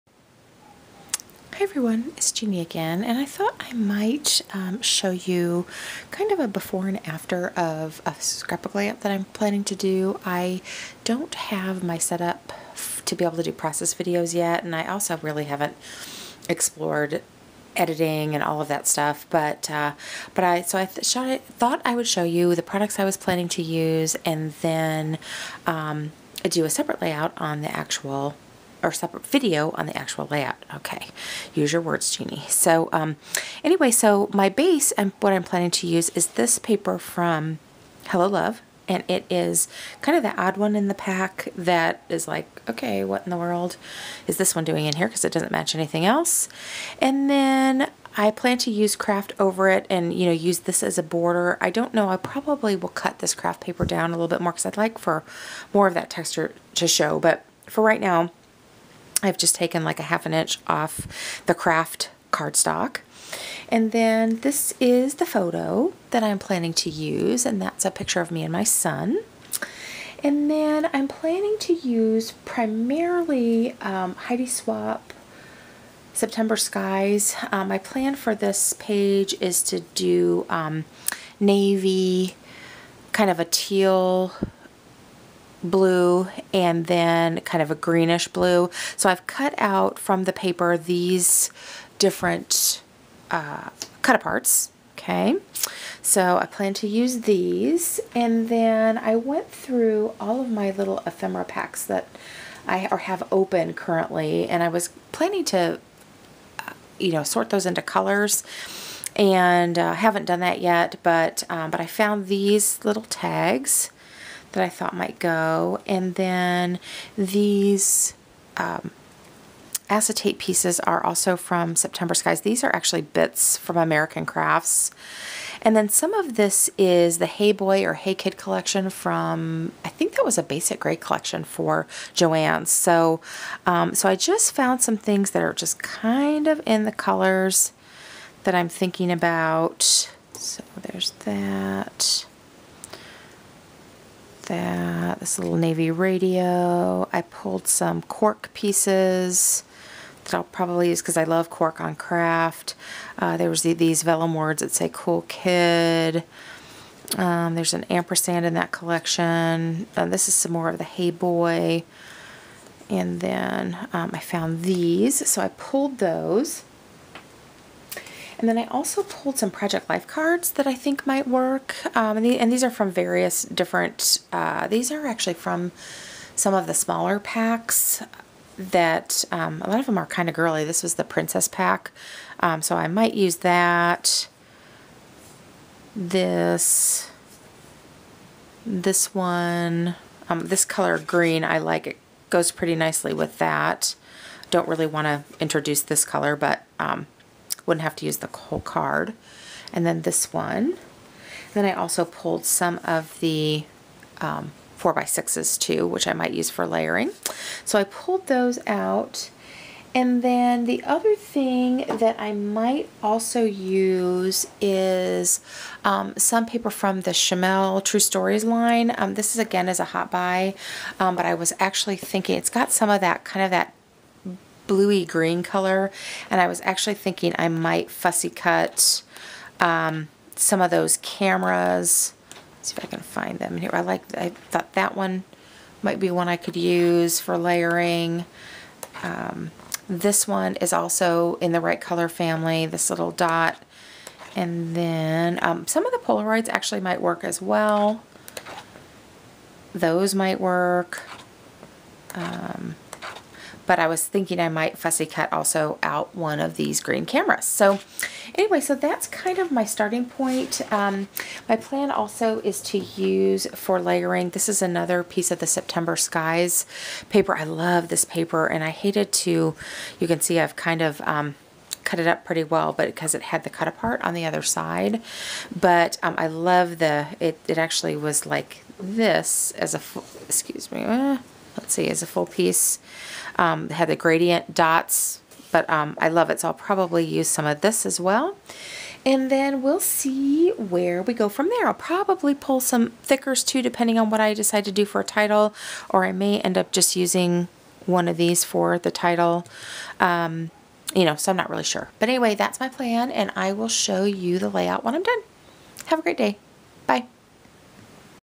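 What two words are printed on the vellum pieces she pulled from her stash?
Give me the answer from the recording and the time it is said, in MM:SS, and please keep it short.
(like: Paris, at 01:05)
cool kid, at 02:34.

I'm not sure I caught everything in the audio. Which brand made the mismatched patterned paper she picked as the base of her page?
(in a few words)
Hello Love.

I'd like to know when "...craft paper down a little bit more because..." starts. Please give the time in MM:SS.
00:53.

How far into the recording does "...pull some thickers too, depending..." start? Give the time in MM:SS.
04:52.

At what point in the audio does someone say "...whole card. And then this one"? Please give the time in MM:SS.
03:18.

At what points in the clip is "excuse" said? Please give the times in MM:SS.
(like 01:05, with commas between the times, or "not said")
04:40.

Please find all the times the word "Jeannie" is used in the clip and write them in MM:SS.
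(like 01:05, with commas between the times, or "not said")
00:02, 00:32.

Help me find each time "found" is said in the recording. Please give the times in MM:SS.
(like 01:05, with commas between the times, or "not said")
01:51, 02:14, 02:44.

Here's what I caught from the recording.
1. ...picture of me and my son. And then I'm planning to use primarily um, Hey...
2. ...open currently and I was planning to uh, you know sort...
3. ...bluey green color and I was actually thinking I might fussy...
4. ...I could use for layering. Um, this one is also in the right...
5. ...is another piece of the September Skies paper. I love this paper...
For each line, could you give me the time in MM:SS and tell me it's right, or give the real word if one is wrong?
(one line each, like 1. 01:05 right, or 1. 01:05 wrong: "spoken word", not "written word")
1. 01:07 wrong: "Heidi", not "Hey"
2. 01:43 right
3. 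03:44 right
4. 03:56 right
5. 04:24 right.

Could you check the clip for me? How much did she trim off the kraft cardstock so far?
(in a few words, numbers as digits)
half an inch.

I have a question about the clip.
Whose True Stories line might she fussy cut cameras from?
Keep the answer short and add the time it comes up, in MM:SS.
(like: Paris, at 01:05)
Shimelle, at 03:37.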